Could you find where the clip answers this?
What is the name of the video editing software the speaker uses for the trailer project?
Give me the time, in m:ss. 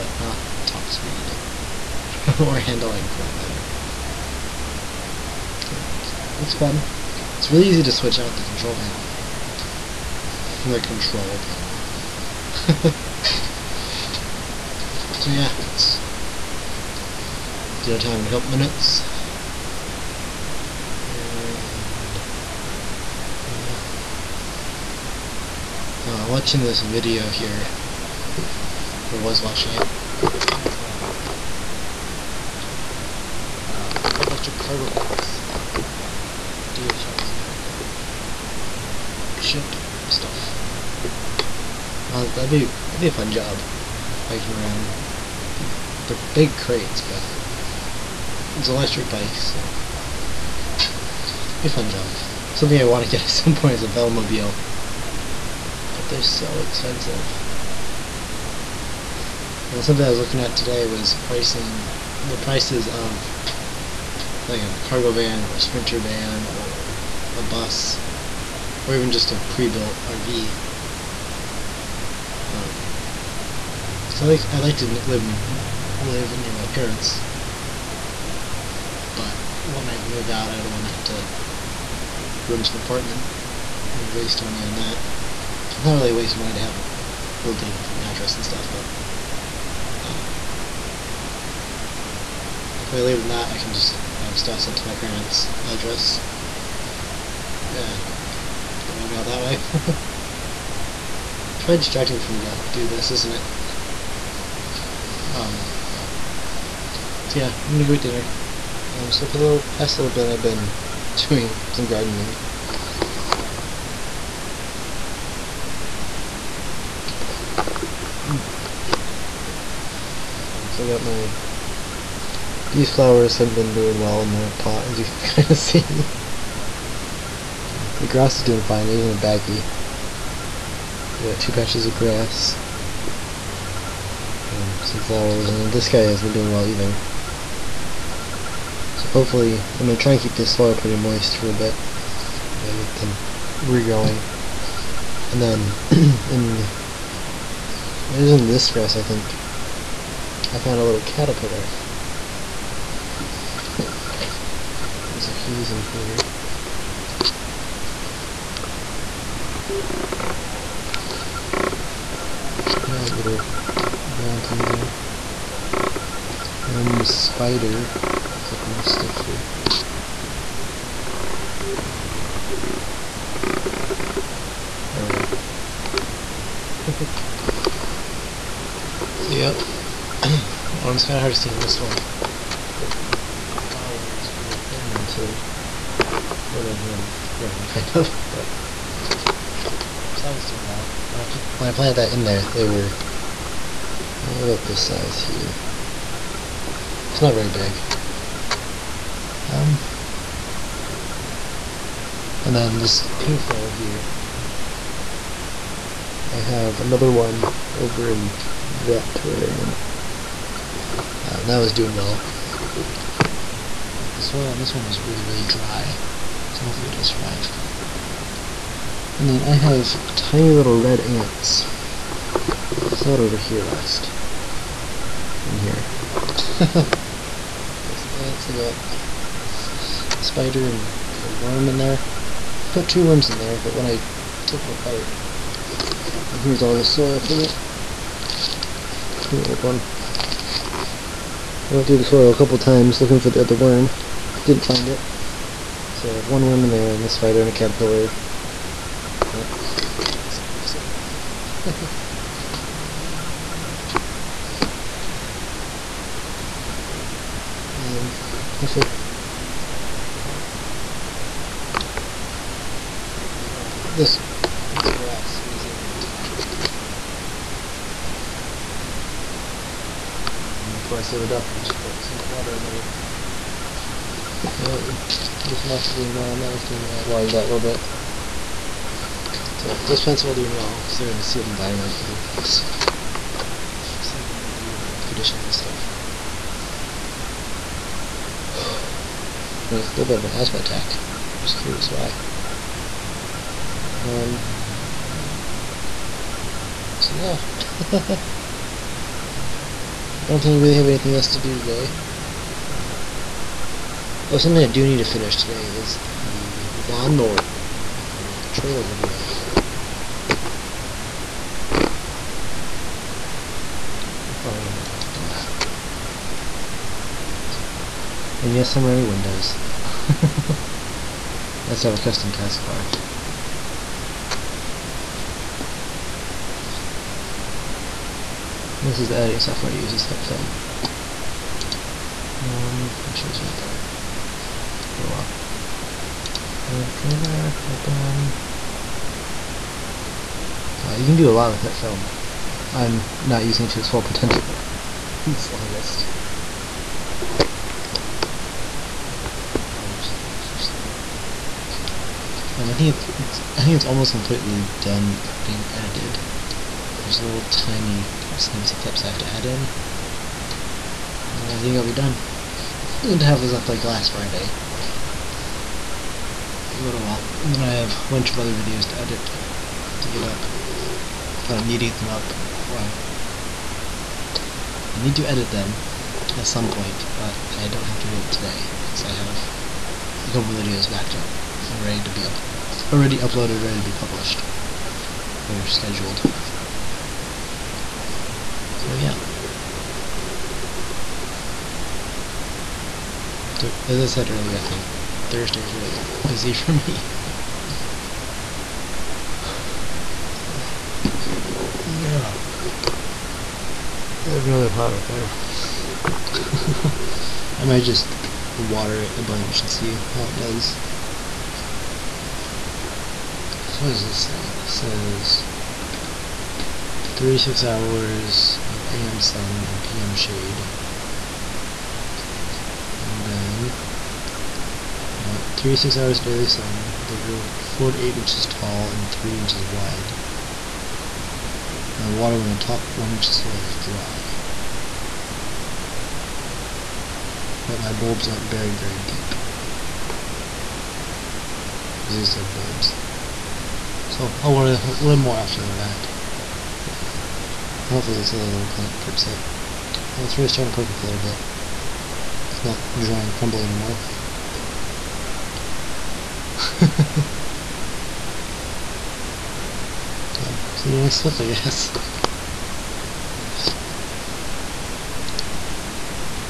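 5:30.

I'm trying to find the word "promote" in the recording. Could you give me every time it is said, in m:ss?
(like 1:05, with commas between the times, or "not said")
not said.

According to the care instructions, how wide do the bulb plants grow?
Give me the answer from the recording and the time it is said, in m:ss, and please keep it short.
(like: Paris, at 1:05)
3 inches, at 7:09.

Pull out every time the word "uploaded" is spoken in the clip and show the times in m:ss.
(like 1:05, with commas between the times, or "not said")
6:23.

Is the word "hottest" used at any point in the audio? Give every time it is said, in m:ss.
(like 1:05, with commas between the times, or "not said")
not said.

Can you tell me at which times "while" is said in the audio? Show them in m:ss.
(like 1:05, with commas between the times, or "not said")
5:35, 6:07.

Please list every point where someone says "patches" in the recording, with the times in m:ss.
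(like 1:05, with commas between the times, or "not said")
2:11.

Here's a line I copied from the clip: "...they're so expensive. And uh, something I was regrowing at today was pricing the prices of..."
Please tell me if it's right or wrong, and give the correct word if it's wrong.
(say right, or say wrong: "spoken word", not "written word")
wrong: "looking", not "regrowing".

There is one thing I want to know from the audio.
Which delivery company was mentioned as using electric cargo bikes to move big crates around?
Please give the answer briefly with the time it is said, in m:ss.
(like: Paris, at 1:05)
DHL, at 0:36.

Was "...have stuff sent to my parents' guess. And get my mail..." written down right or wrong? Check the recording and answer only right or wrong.
wrong.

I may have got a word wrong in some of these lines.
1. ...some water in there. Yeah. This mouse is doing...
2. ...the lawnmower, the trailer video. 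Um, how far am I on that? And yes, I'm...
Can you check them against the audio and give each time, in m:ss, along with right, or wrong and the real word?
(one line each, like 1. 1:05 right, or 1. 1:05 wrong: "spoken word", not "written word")
1. 4:32 right
2. 5:08 right.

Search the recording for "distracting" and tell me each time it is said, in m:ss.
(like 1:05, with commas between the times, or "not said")
1:41.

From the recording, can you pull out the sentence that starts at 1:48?
Um, so for the little, past little bit I've been doing some gardening.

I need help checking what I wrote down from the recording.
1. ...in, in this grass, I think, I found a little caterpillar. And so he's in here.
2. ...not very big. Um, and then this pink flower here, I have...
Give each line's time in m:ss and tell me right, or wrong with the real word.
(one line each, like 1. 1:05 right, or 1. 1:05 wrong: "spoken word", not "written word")
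1. 2:26 right
2. 3:17 right.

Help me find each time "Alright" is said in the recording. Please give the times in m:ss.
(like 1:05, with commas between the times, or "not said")
5:36.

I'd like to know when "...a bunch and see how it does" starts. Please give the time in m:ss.
6:49.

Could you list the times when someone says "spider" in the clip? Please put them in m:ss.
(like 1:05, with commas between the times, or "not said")
2:47, 3:50, 4:07.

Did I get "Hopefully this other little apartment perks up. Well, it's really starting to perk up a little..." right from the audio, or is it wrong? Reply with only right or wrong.
wrong.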